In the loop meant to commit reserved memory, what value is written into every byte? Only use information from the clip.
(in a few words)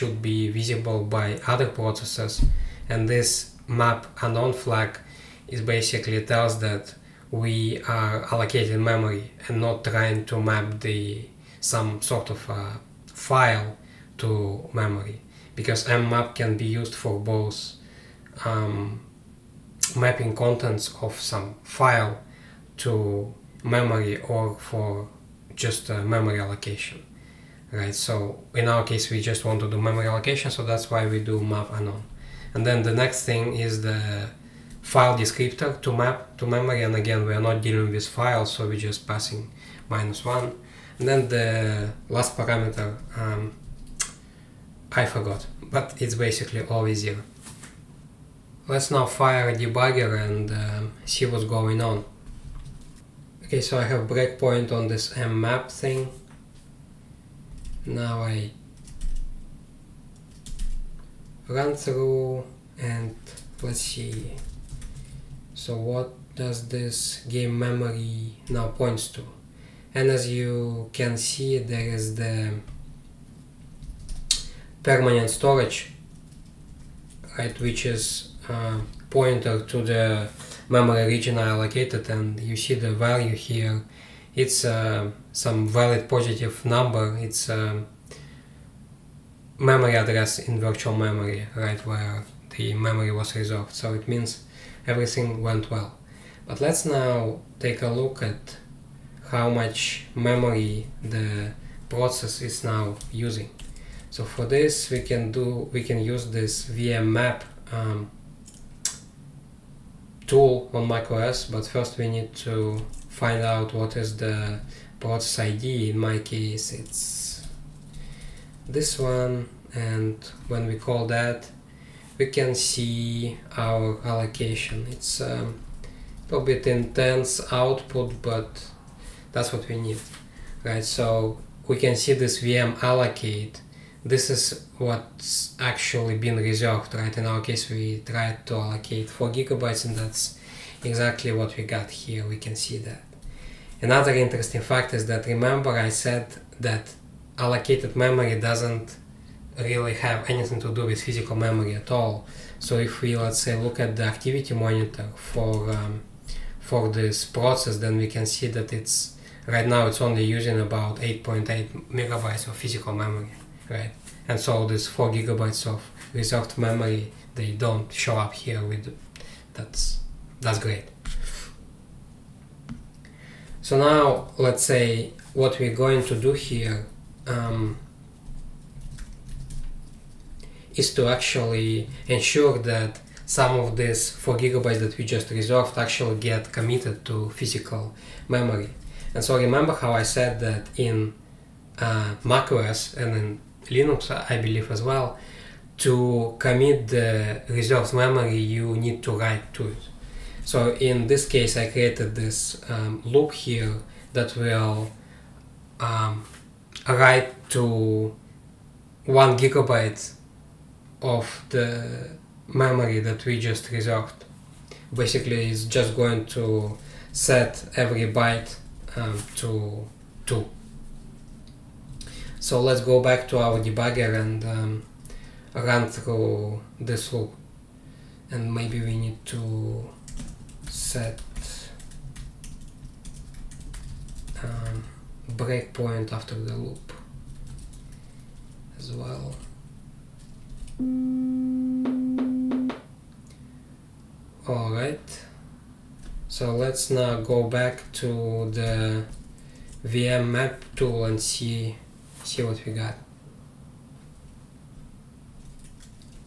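2.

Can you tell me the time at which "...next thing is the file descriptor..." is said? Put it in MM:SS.
00:32.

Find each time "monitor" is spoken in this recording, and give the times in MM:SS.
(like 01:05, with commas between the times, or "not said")
02:34.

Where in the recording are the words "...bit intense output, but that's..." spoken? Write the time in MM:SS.
02:06.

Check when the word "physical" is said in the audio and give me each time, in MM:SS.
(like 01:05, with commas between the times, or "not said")
02:31, 02:42, 03:07.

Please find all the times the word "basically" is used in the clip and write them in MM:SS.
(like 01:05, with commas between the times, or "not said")
00:05, 00:46, 03:34.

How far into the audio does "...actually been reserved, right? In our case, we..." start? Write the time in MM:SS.
02:15.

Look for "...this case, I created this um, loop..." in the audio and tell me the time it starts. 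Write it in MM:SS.
03:21.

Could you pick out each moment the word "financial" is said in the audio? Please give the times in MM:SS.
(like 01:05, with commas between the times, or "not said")
not said.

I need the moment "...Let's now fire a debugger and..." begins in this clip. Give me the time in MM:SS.
00:48.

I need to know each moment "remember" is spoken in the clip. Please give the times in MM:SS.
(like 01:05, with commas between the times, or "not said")
02:25, 03:09.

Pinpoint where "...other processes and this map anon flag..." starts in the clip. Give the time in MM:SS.
00:01.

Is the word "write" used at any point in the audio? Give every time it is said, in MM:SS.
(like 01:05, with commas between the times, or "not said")
03:19, 03:26.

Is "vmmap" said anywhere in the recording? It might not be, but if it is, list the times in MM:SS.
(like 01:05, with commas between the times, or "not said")
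01:46, 04:09.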